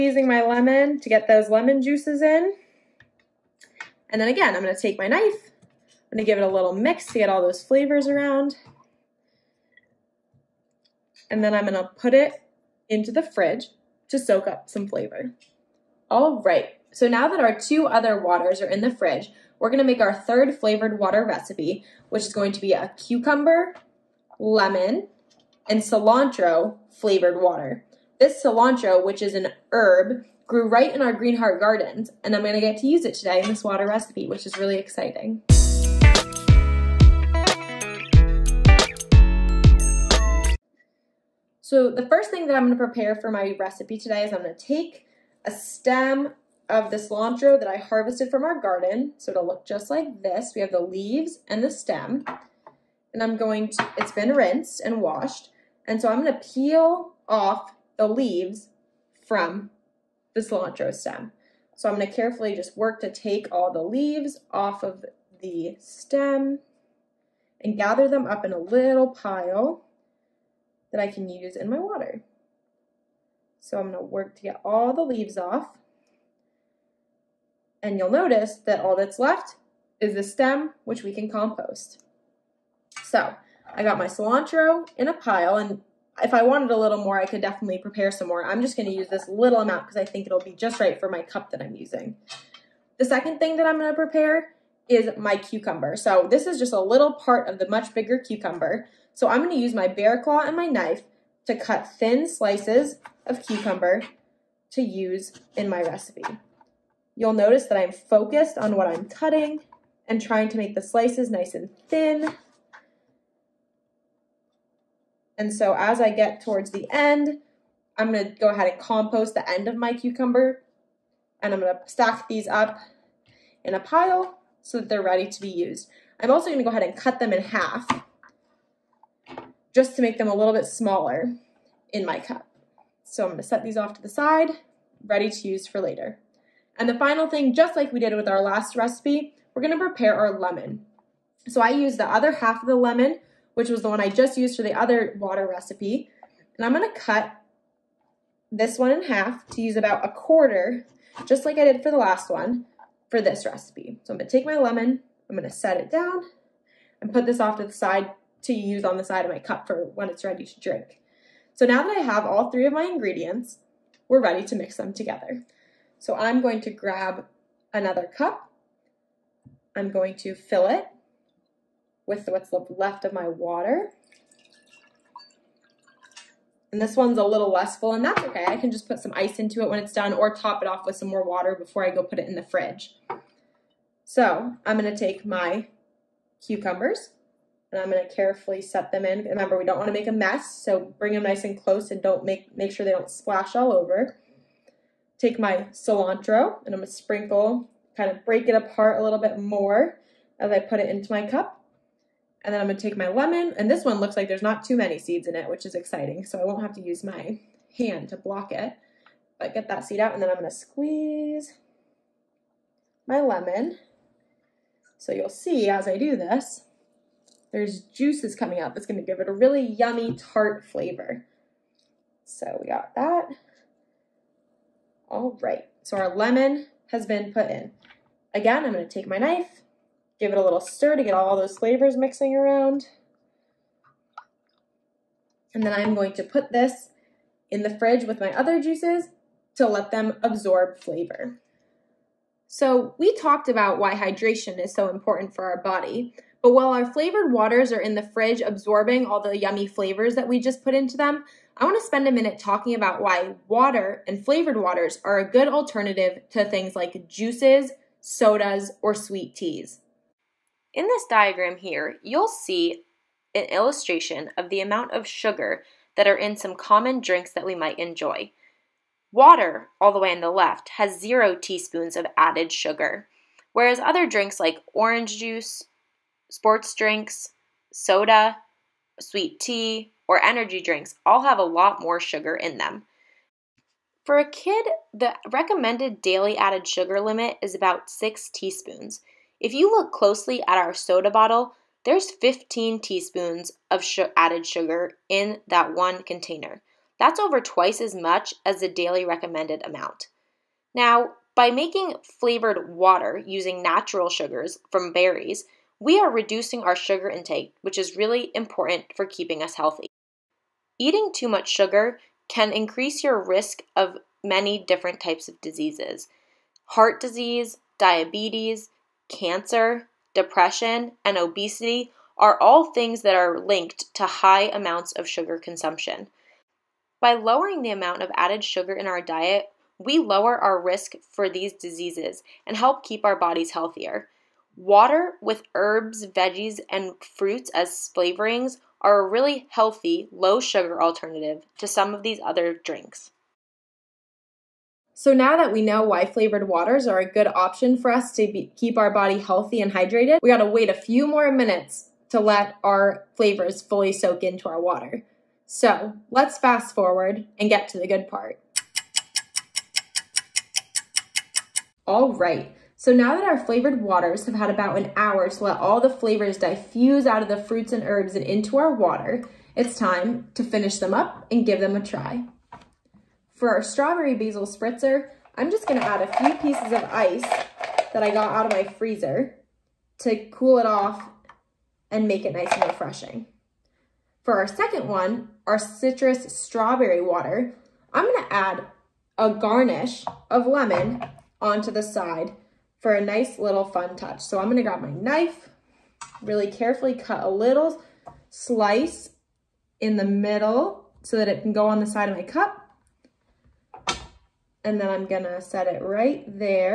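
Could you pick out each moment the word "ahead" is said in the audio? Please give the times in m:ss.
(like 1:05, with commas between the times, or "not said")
1:58, 2:06.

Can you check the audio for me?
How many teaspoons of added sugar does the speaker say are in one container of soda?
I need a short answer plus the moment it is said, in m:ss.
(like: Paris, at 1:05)
15 teaspoons, at 4:52.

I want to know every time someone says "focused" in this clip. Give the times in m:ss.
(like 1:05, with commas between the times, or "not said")
1:47.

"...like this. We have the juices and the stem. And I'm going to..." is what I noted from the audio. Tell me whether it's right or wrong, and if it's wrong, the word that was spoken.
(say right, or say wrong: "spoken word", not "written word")
wrong: "leaves", not "juices".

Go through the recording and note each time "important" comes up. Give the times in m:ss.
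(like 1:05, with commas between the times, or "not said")
4:04, 5:08.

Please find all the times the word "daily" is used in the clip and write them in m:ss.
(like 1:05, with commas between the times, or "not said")
4:45, 4:58.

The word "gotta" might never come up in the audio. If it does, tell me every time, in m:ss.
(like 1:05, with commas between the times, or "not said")
5:50.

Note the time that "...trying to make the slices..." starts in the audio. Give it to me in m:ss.
1:50.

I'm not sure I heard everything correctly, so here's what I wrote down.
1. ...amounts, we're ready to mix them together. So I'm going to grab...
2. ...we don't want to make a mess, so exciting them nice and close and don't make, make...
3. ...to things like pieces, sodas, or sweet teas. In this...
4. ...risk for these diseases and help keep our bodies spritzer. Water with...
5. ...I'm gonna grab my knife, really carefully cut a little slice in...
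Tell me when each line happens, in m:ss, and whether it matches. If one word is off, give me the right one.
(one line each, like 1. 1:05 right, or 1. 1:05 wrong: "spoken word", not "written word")
1. 2:42 wrong: "ingredients", not "amounts"
2. 3:09 wrong: "bring", not "exciting"
3. 4:16 wrong: "juices", not "pieces"
4. 5:30 wrong: "healthier", not "spritzer"
5. 6:34 right.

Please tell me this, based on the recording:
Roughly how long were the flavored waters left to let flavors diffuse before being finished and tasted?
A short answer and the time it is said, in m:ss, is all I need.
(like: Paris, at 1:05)
About an hour, at 6:04.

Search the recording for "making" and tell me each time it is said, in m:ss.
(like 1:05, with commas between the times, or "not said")
5:01.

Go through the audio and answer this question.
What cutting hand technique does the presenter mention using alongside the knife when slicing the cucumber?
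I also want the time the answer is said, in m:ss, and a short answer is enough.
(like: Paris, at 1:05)
Bear claw, at 1:39.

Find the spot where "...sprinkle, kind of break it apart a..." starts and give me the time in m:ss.
3:16.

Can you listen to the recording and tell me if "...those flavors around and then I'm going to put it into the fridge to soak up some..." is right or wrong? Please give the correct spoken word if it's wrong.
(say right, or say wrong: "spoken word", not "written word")
right.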